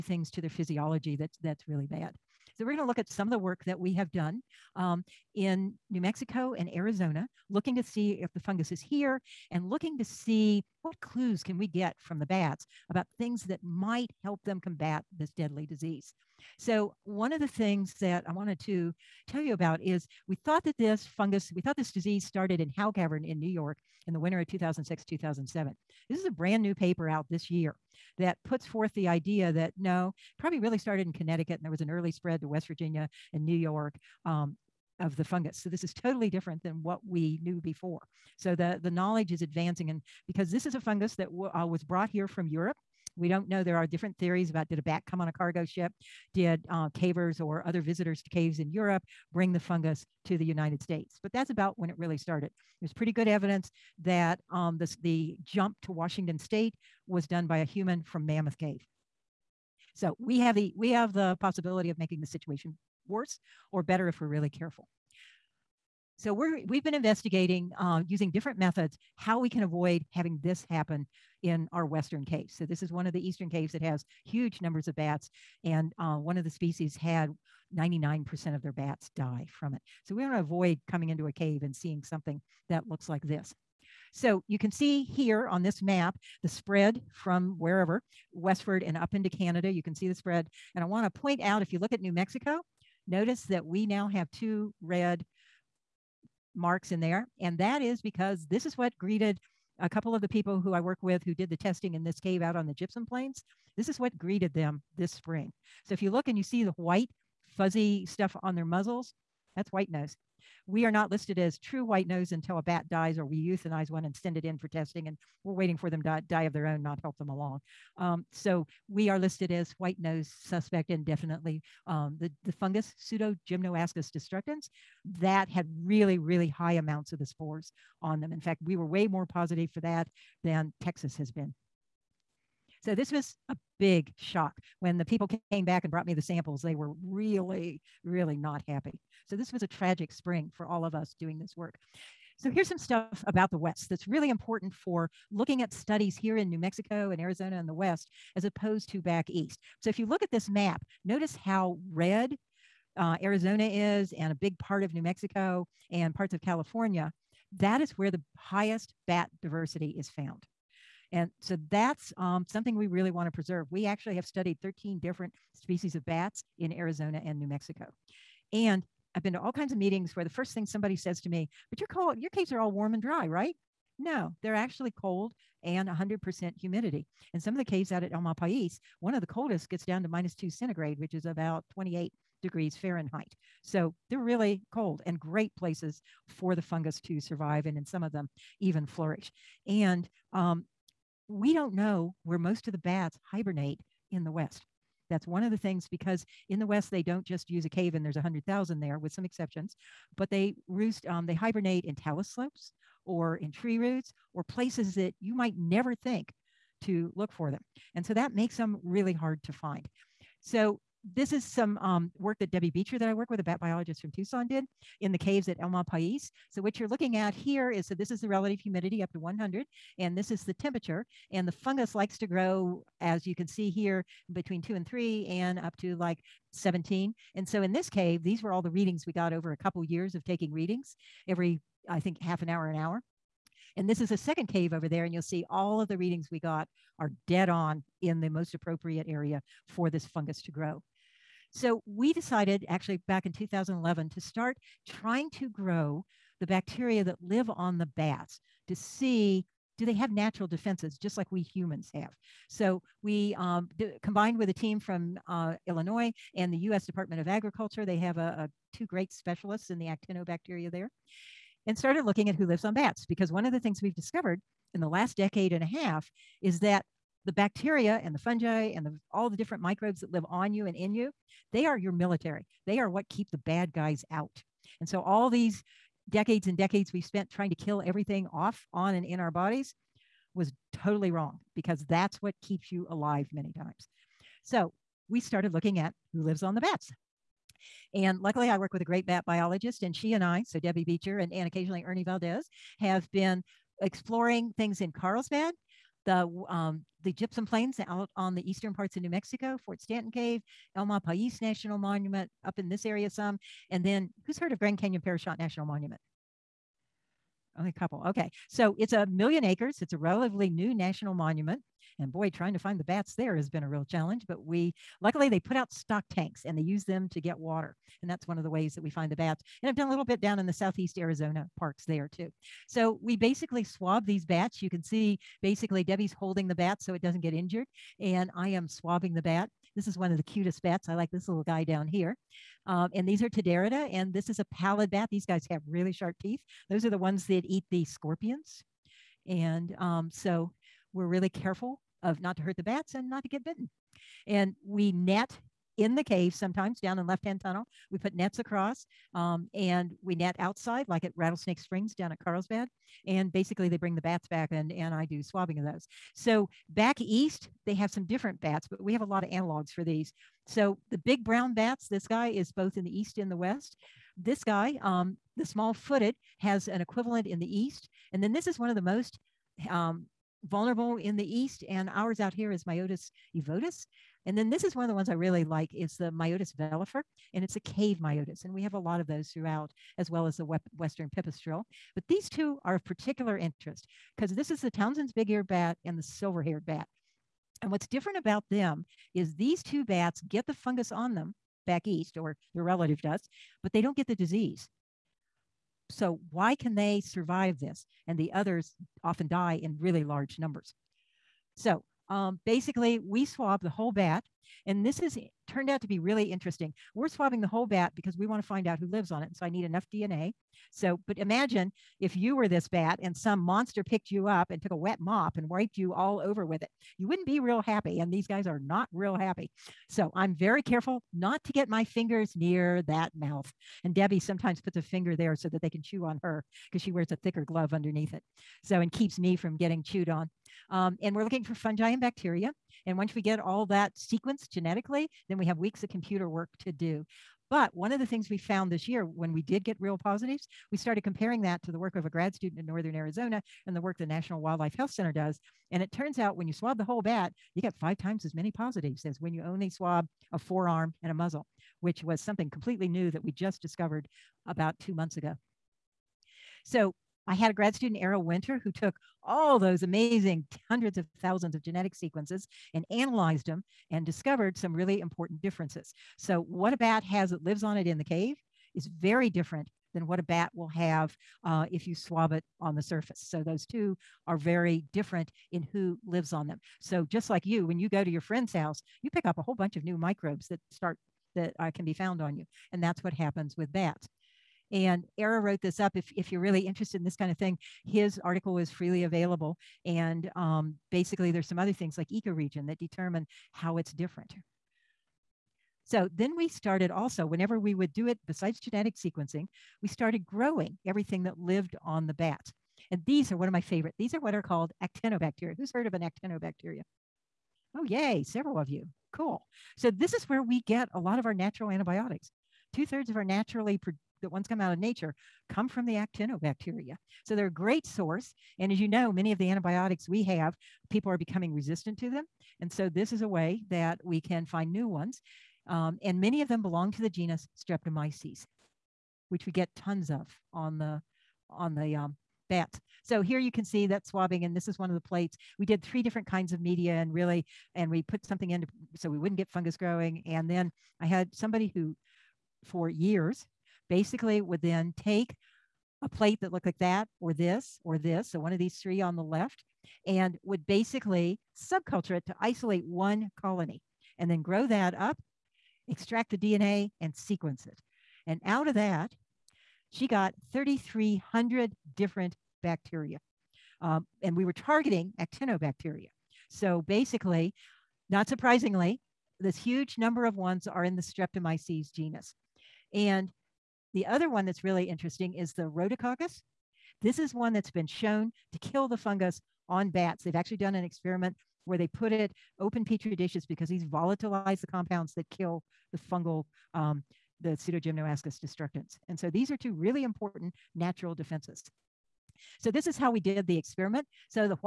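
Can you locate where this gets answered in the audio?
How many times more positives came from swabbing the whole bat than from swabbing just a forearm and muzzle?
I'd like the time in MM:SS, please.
07:27.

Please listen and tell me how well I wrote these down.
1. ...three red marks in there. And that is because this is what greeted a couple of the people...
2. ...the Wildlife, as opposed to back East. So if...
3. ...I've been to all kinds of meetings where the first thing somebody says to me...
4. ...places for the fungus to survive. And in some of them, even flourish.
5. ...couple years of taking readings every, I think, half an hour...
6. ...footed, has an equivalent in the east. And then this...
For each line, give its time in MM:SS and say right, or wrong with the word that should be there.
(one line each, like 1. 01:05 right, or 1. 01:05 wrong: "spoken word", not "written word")
1. 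01:34 wrong: "two", not "three"
2. 02:27 wrong: "West", not "Wildlife"
3. 02:49 right
4. 03:05 right
5. 03:49 right
6. 06:05 right.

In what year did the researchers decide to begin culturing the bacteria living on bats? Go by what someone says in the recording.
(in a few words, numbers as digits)
2011.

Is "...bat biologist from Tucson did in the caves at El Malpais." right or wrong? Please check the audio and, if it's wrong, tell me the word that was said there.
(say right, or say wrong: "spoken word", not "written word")
right.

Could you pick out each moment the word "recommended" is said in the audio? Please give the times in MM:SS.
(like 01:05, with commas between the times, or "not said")
not said.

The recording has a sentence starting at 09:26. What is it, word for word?
So basically, not surprisingly, this huge number of ones are in the Streptomyces genus.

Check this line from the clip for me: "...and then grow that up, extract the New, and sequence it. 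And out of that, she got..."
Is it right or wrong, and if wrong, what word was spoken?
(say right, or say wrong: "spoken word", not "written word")
wrong: "DNA", not "New".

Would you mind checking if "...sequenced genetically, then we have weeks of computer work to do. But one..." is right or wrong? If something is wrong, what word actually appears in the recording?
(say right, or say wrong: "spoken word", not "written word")
right.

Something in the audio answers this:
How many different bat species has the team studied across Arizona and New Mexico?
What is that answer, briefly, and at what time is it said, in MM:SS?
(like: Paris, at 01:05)
13, at 02:44.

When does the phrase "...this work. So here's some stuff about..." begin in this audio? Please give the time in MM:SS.
02:21.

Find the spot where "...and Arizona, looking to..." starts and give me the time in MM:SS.
00:06.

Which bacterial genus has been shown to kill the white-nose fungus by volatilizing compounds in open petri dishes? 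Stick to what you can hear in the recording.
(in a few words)
Rhodococcus.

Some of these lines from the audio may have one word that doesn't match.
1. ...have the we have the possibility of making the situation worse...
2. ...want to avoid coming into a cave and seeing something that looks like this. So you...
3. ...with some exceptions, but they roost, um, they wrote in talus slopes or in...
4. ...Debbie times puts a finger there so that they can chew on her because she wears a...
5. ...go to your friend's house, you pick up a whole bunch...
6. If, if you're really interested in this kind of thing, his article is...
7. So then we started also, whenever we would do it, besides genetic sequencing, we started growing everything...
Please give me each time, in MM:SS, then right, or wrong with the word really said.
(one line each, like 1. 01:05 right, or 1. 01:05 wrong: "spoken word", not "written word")
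1. 01:00 right
2. 01:20 right
3. 03:18 wrong: "hibernate", not "wrote"
4. 07:03 wrong: "sometimes", not "times"
5. 07:57 right
6. 08:05 right
7. 08:15 right.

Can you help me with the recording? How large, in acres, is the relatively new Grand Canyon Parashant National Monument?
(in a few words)
a million acres.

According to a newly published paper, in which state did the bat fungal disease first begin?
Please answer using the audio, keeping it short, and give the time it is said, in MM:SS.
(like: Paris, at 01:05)
Connecticut, at 00:31.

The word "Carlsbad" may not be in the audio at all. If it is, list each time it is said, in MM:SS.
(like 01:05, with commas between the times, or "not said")
04:54, 05:52.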